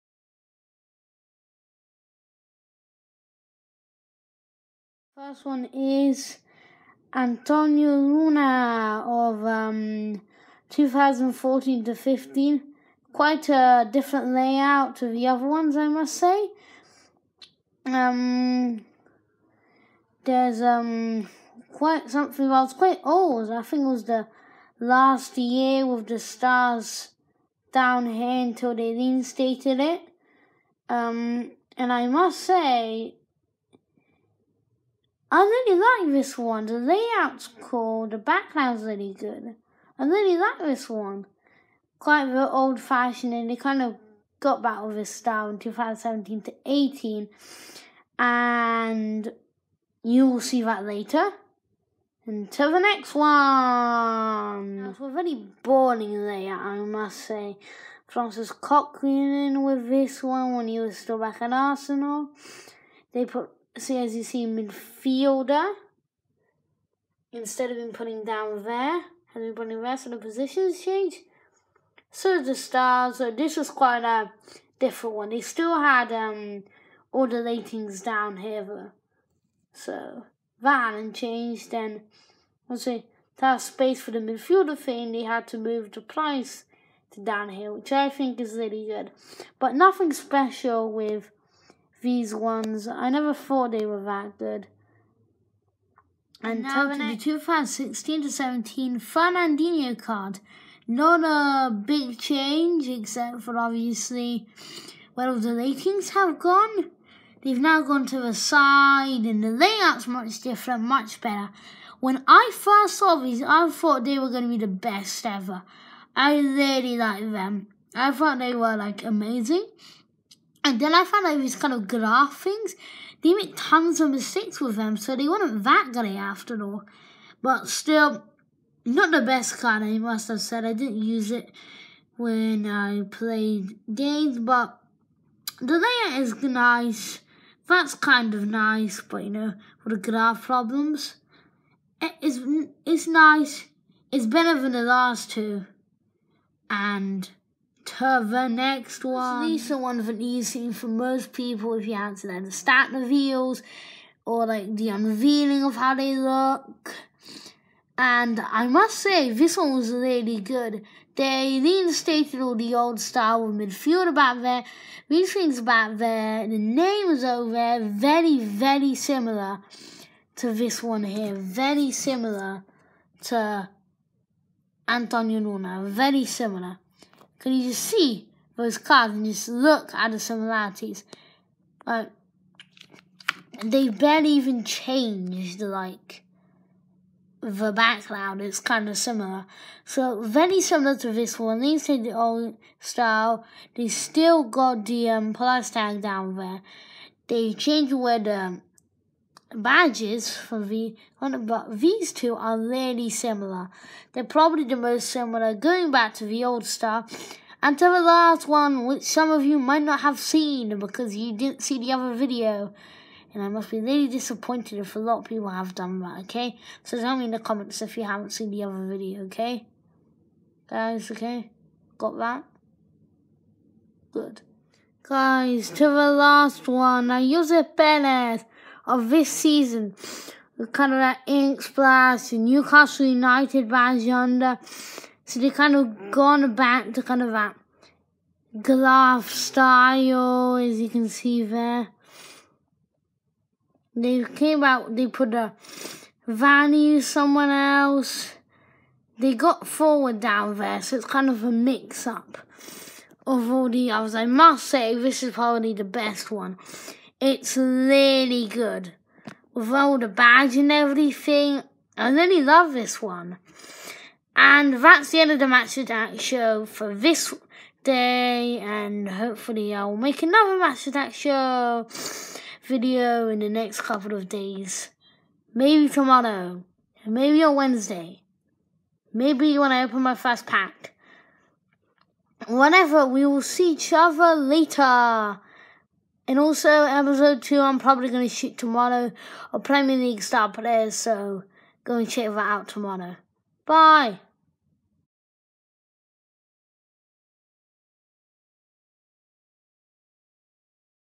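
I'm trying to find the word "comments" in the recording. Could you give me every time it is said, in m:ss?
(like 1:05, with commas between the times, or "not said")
3:37.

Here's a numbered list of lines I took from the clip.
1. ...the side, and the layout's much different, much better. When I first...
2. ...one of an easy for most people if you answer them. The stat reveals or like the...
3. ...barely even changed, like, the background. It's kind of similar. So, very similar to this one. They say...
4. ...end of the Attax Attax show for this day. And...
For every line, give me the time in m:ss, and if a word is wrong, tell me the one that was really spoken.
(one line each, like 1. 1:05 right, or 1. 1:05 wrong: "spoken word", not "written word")
1. 1:48 right
2. 2:29 right
3. 3:03 right
4. 4:25 wrong: "Match", not "Attax".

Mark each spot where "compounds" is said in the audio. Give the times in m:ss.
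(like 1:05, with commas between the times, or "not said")
not said.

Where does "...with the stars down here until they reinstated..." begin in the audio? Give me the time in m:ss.
0:25.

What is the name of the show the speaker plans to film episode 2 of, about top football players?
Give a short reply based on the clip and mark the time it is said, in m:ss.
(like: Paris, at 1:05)
Premier League Star Players, at 4:49.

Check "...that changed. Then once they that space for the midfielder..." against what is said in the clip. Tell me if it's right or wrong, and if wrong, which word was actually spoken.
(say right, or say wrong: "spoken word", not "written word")
right.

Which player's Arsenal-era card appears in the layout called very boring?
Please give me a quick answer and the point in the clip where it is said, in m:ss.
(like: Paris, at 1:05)
Francis Coquelin, at 0:58.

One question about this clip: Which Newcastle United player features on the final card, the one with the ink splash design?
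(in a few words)
Ayoze Perez.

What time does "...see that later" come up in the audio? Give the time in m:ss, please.
0:50.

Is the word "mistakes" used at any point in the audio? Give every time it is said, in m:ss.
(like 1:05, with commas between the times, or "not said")
2:04.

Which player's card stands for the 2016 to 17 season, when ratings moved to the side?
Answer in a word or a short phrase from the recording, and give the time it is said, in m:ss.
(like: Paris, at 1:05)
Fernandinho, at 1:38.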